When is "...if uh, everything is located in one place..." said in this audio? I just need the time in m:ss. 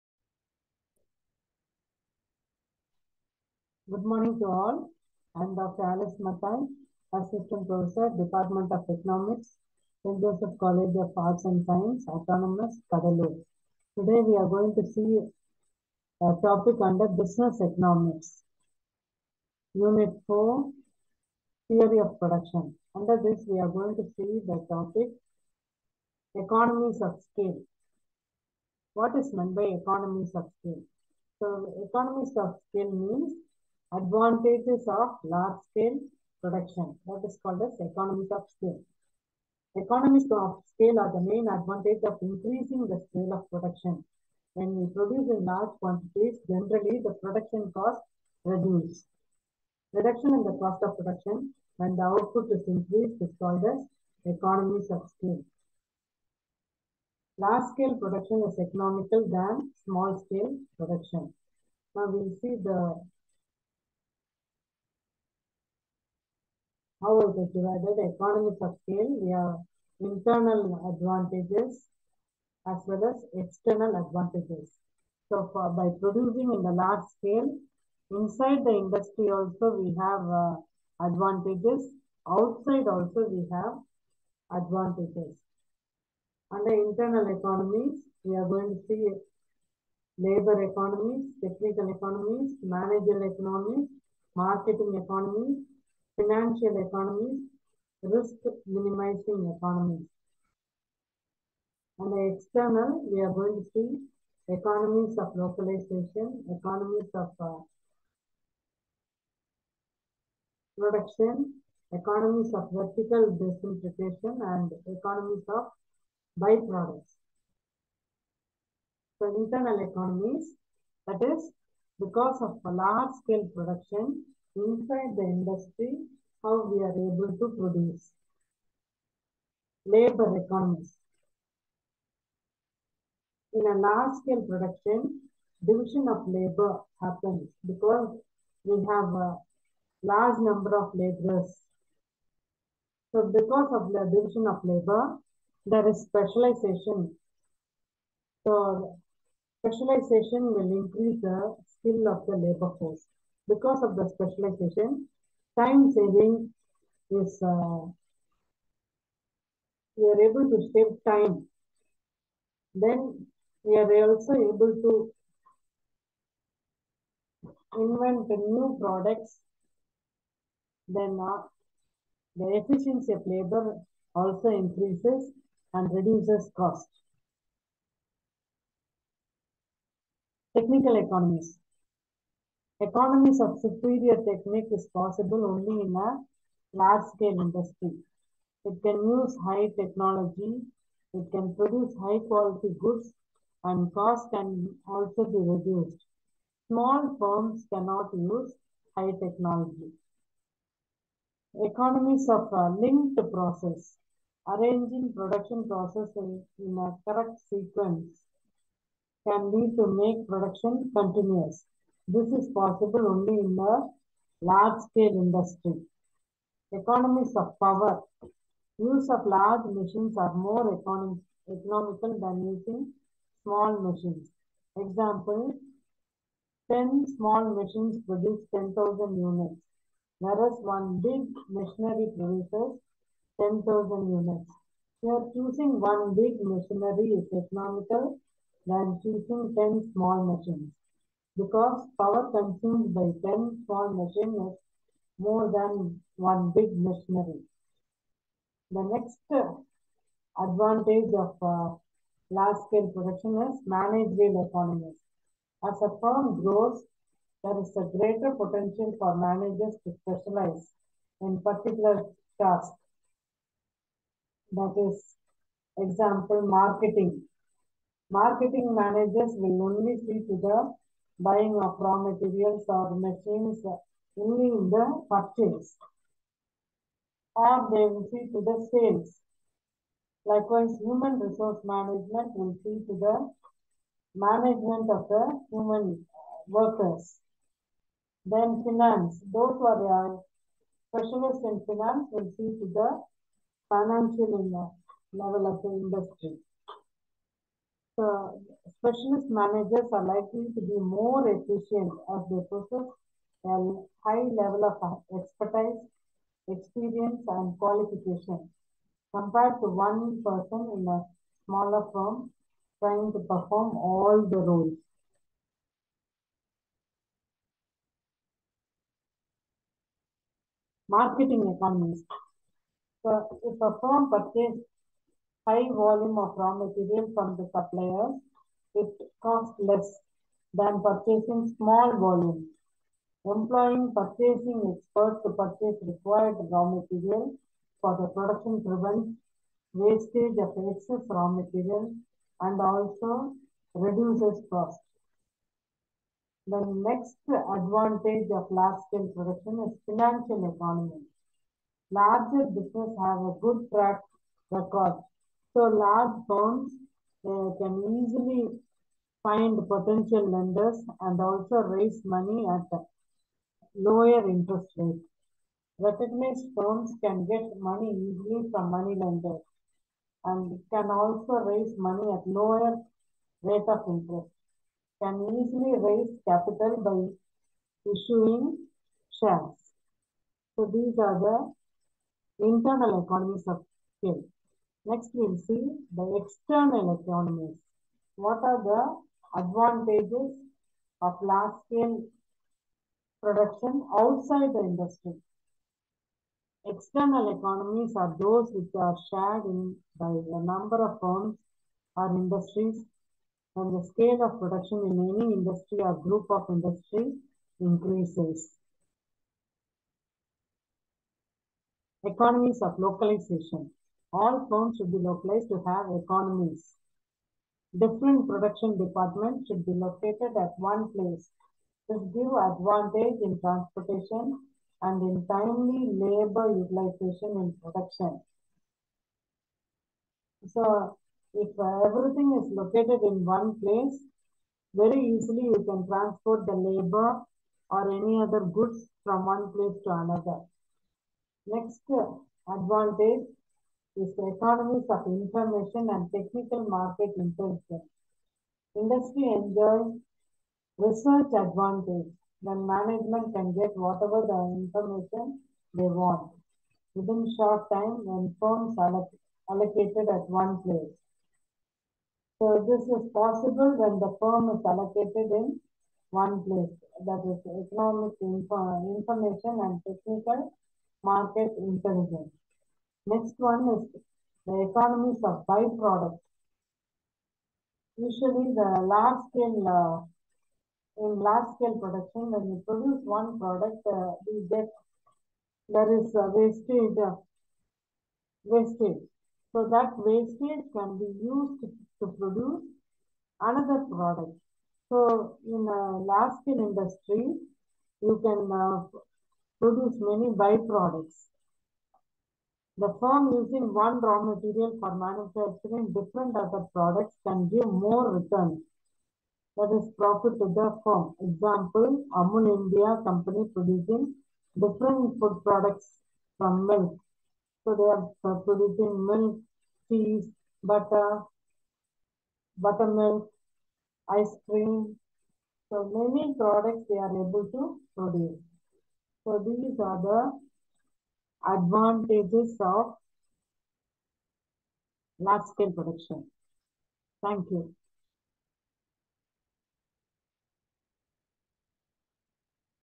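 7:11.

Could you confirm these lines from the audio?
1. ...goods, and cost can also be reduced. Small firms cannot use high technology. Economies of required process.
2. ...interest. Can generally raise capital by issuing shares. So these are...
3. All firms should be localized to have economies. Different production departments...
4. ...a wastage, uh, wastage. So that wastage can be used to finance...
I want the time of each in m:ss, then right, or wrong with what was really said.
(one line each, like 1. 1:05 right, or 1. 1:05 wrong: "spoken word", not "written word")
1. 3:12 wrong: "linked", not "required"
2. 6:13 wrong: "easily", not "generally"
3. 6:54 right
4. 8:06 wrong: "produce", not "finance".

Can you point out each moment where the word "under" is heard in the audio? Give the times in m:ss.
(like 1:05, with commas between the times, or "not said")
0:16, 0:22, 1:26.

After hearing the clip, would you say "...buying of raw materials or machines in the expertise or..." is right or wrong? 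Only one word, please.
wrong.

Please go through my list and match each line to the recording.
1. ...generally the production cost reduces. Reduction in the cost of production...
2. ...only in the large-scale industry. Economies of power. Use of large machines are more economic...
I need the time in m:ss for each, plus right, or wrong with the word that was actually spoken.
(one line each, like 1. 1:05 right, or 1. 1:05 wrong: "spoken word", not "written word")
1. 0:46 right
2. 3:33 right.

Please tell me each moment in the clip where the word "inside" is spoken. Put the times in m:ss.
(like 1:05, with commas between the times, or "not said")
1:18, 2:04.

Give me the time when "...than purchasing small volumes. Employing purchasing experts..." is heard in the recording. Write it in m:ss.
5:30.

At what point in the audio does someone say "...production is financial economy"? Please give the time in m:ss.
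5:49.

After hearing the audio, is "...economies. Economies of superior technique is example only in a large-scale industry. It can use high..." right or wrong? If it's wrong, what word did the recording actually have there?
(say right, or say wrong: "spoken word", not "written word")
wrong: "possible", not "example".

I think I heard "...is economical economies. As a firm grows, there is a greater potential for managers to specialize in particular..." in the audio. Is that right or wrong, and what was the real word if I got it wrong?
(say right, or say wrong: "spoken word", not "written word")
wrong: "managerial", not "economical".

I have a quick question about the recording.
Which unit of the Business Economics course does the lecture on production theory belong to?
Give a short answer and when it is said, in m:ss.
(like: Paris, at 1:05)
Unit 4, at 0:19.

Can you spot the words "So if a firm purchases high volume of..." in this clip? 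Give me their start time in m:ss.
5:23.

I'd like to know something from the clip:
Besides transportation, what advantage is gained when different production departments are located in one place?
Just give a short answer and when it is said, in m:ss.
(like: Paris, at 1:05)
Timely labor utilization, at 7:05.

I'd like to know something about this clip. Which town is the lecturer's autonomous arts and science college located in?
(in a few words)
Cuddalore.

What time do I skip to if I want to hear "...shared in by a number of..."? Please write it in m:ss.
6:39.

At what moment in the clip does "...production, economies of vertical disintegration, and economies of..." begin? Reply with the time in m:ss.
1:50.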